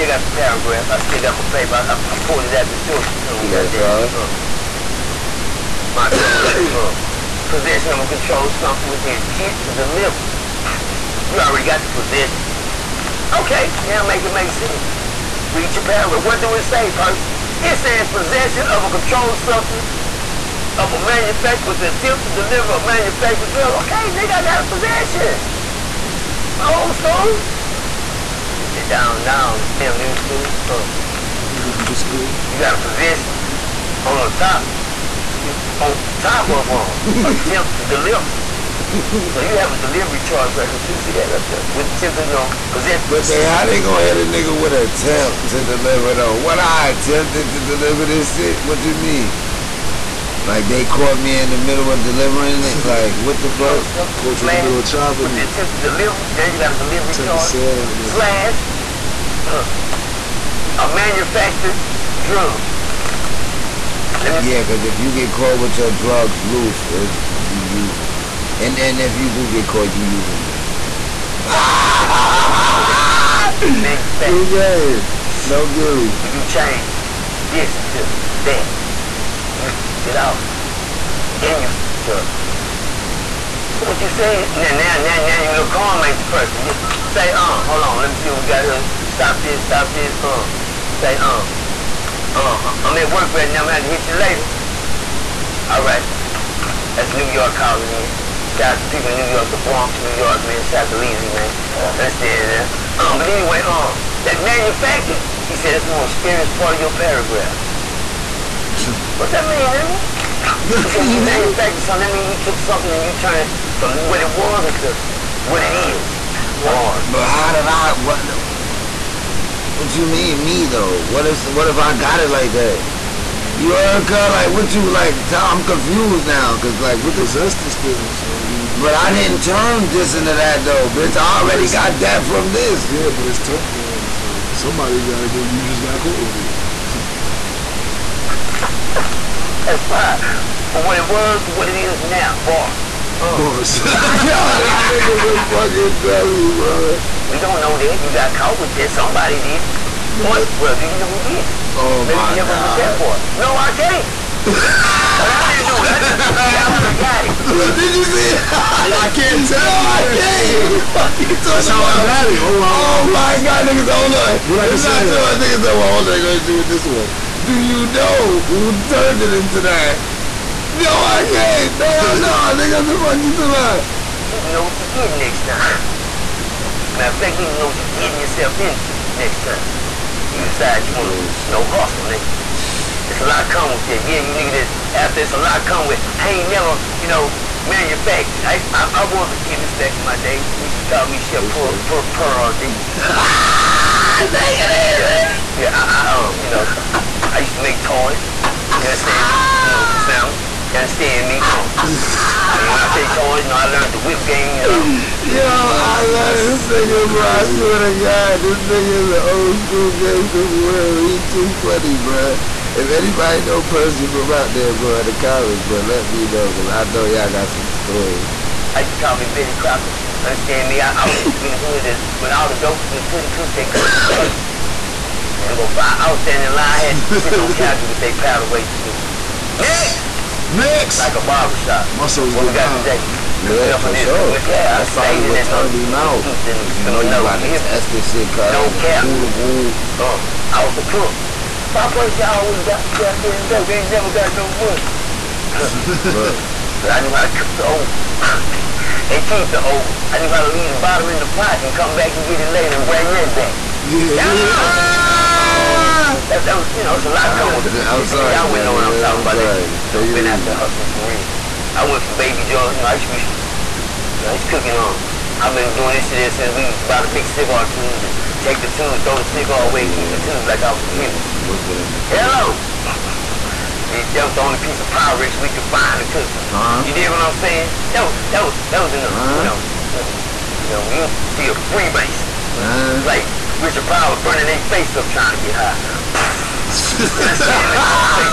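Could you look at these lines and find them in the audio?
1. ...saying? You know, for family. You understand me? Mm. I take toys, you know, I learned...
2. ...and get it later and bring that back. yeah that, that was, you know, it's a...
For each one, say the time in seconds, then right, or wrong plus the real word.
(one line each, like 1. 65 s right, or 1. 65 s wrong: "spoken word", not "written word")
1. 198 s right
2. 252 s right.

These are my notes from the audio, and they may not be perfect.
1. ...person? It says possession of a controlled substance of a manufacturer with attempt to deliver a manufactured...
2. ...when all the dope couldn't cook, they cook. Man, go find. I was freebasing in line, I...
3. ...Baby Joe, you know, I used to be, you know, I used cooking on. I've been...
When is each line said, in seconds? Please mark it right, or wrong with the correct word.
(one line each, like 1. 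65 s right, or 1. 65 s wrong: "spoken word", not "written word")
1. 16 s right
2. 222 s wrong: "standing", not "freebasing"
3. 262 s right.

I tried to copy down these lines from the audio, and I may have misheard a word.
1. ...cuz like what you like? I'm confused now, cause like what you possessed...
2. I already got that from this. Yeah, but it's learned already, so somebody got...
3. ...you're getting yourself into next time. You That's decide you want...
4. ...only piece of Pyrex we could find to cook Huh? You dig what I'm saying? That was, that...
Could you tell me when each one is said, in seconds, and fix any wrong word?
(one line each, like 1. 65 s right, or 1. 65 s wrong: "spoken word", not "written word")
1. 124 s right
2. 131 s wrong: "turned", not "learned"
3. 177 s right
4. 274 s right.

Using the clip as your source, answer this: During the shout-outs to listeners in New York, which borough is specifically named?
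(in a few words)
The Bronx.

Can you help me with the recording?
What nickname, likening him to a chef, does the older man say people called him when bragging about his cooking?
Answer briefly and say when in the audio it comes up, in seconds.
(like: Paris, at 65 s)
Chef Pearl, at 191 s.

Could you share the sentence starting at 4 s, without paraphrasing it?
Uh, my uh, possession of a controlled substance with the intent to deliver.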